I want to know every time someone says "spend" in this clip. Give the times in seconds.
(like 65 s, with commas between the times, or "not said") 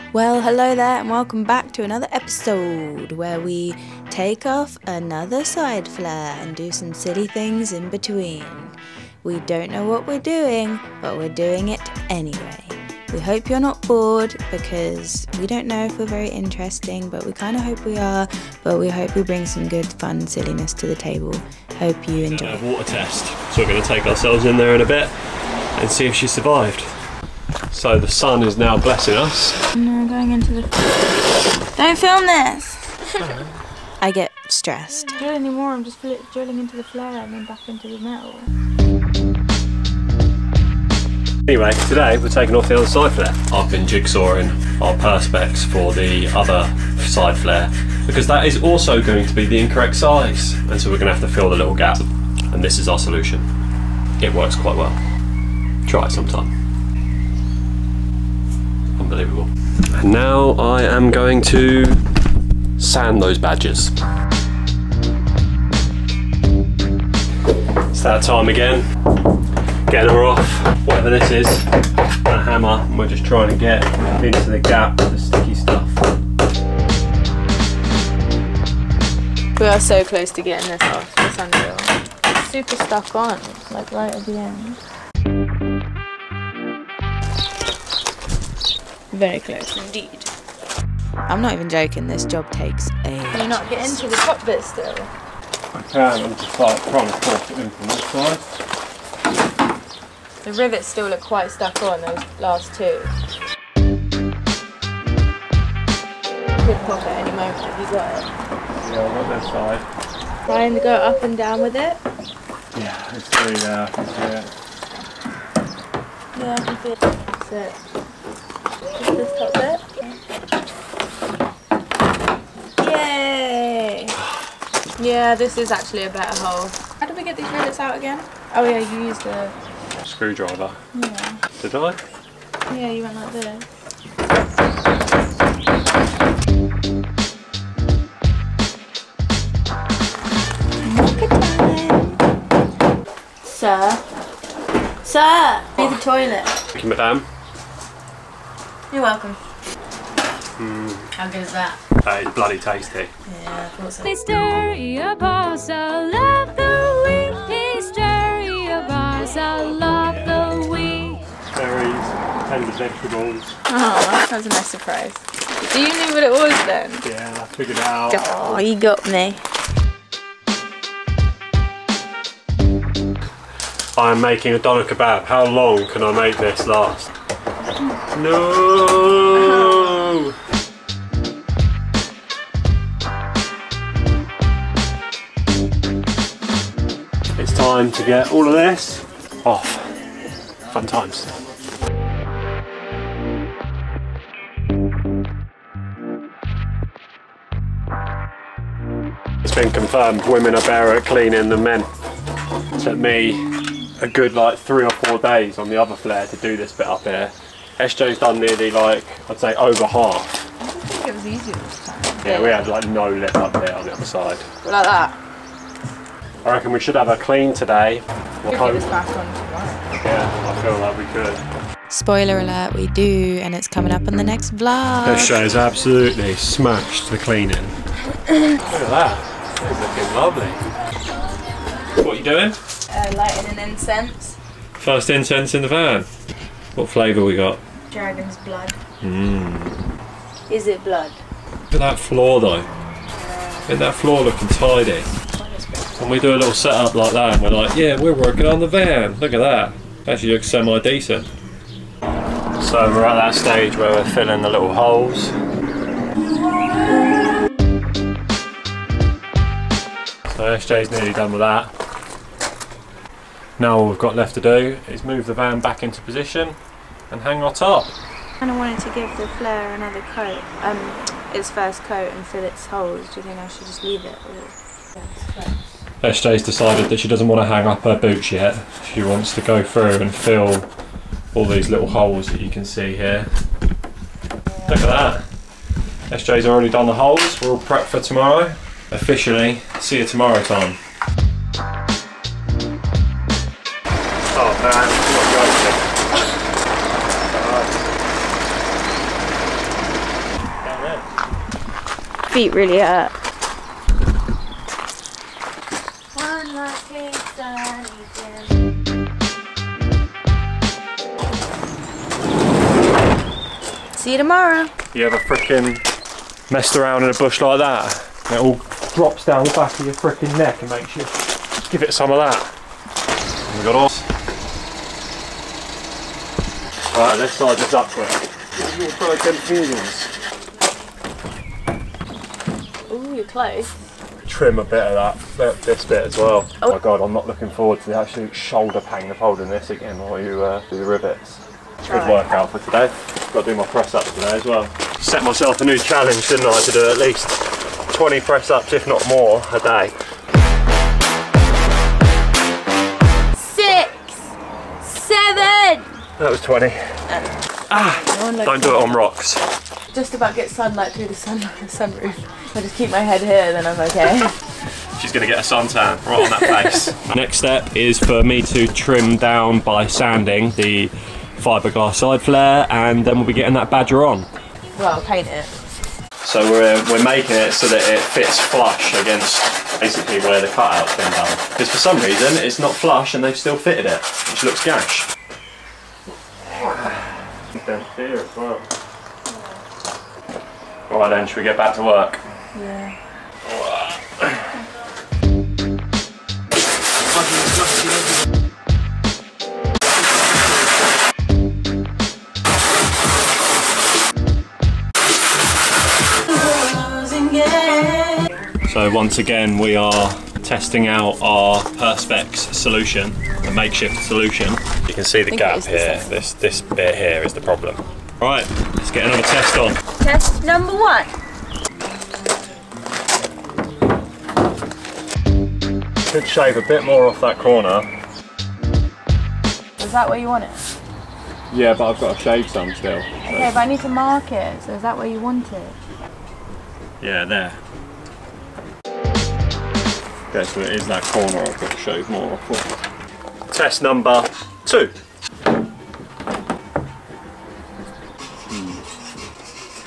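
not said.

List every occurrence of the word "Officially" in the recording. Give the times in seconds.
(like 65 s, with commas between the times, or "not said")
288 s.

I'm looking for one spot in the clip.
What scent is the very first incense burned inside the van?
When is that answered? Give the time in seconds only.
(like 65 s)
237 s.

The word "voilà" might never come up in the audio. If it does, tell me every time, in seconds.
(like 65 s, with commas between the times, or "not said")
not said.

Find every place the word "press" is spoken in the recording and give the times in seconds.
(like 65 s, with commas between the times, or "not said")
343 s, 348 s.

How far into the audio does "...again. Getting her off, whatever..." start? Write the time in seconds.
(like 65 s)
68 s.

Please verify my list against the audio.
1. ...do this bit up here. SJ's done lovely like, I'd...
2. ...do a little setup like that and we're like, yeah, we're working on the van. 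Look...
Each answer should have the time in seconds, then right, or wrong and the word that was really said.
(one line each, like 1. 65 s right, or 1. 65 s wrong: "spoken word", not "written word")
1. 206 s wrong: "nearly", not "lovely"
2. 246 s right.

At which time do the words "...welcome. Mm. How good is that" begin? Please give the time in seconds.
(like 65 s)
149 s.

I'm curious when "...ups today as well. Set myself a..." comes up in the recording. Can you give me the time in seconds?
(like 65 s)
343 s.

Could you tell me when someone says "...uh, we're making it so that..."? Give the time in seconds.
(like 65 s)
376 s.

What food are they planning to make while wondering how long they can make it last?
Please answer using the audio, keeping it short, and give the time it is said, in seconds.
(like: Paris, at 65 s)
Doner kebab, at 174 s.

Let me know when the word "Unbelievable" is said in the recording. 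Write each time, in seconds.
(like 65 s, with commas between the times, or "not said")
59 s.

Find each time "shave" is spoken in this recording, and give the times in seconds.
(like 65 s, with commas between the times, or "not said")
426 s, 432 s, 441 s.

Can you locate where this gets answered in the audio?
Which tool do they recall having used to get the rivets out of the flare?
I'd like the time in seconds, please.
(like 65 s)
130 s.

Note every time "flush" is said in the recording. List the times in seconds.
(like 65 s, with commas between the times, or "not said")
378 s, 382 s.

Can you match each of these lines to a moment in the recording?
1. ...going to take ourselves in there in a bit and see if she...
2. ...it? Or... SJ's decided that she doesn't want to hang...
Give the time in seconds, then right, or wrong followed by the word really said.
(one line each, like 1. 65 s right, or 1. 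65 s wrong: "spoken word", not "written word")
1. 23 s right
2. 274 s right.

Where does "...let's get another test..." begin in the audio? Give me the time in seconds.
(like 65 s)
418 s.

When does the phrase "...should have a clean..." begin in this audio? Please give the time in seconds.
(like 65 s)
216 s.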